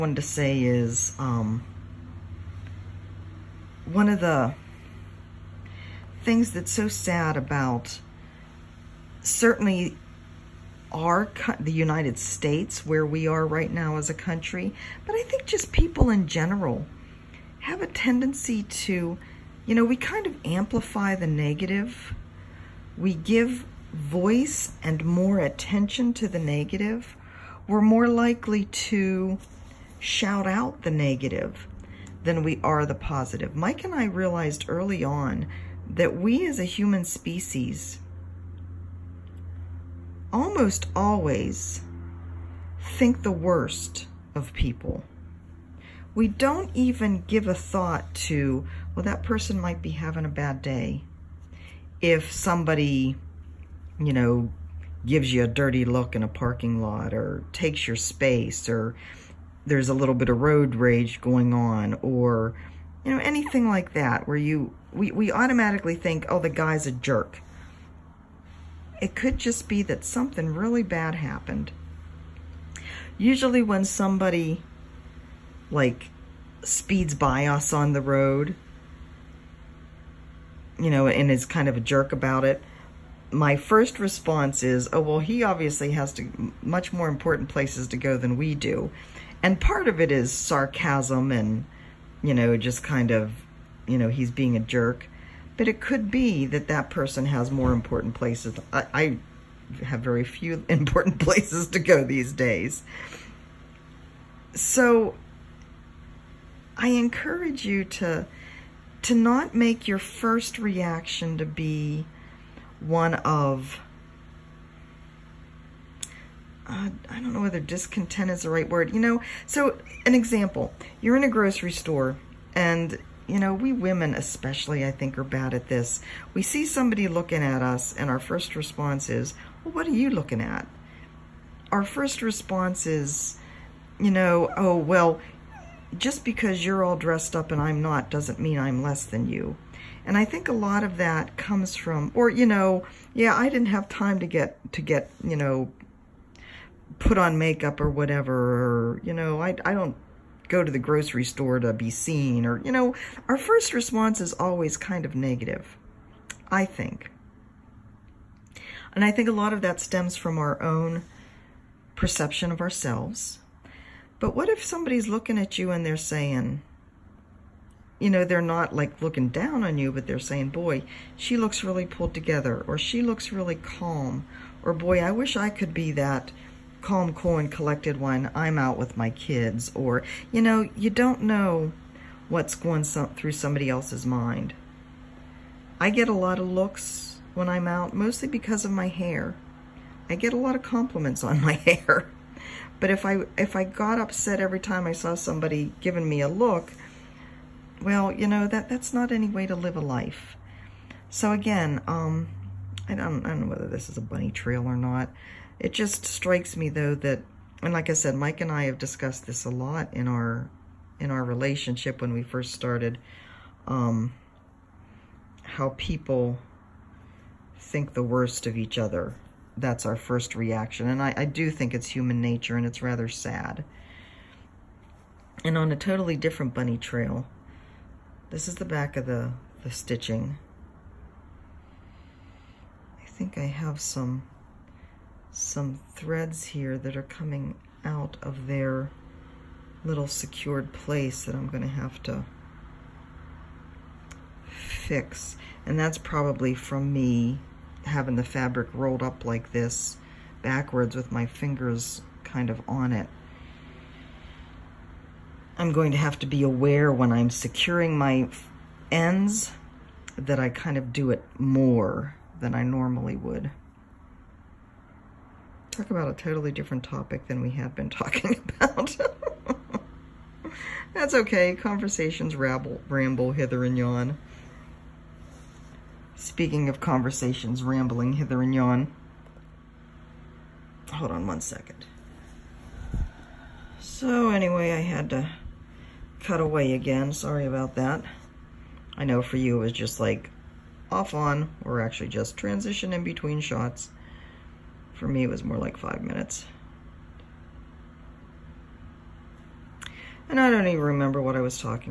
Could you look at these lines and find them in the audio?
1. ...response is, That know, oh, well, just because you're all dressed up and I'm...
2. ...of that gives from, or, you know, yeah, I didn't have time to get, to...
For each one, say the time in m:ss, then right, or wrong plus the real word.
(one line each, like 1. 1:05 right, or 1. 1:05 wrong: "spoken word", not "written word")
1. 2:12 wrong: "You", not "That"
2. 2:20 wrong: "comes", not "gives".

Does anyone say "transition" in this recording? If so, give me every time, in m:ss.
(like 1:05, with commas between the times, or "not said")
4:52.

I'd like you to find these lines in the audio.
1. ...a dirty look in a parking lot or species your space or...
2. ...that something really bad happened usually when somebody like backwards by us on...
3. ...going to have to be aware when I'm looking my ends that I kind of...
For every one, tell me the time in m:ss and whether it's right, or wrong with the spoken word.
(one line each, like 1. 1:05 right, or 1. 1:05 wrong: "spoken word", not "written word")
1. 0:55 wrong: "takes", not "species"
2. 1:09 wrong: "speeds", not "backwards"
3. 4:15 wrong: "securing", not "looking".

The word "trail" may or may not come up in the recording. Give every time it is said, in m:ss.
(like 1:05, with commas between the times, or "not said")
3:24, 3:46.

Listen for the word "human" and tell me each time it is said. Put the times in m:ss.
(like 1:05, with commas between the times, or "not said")
0:36, 3:41.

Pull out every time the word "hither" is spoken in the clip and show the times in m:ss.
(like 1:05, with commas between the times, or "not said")
4:33, 4:38.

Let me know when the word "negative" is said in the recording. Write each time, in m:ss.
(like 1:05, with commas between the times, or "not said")
0:21, 0:26, 0:30, 2:35.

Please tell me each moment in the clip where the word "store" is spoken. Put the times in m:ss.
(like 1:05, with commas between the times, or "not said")
2:01, 2:31.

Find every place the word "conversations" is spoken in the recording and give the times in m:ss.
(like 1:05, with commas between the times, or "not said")
4:31, 4:36.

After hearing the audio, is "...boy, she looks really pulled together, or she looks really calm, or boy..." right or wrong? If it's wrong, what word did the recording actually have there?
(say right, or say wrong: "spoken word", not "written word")
right.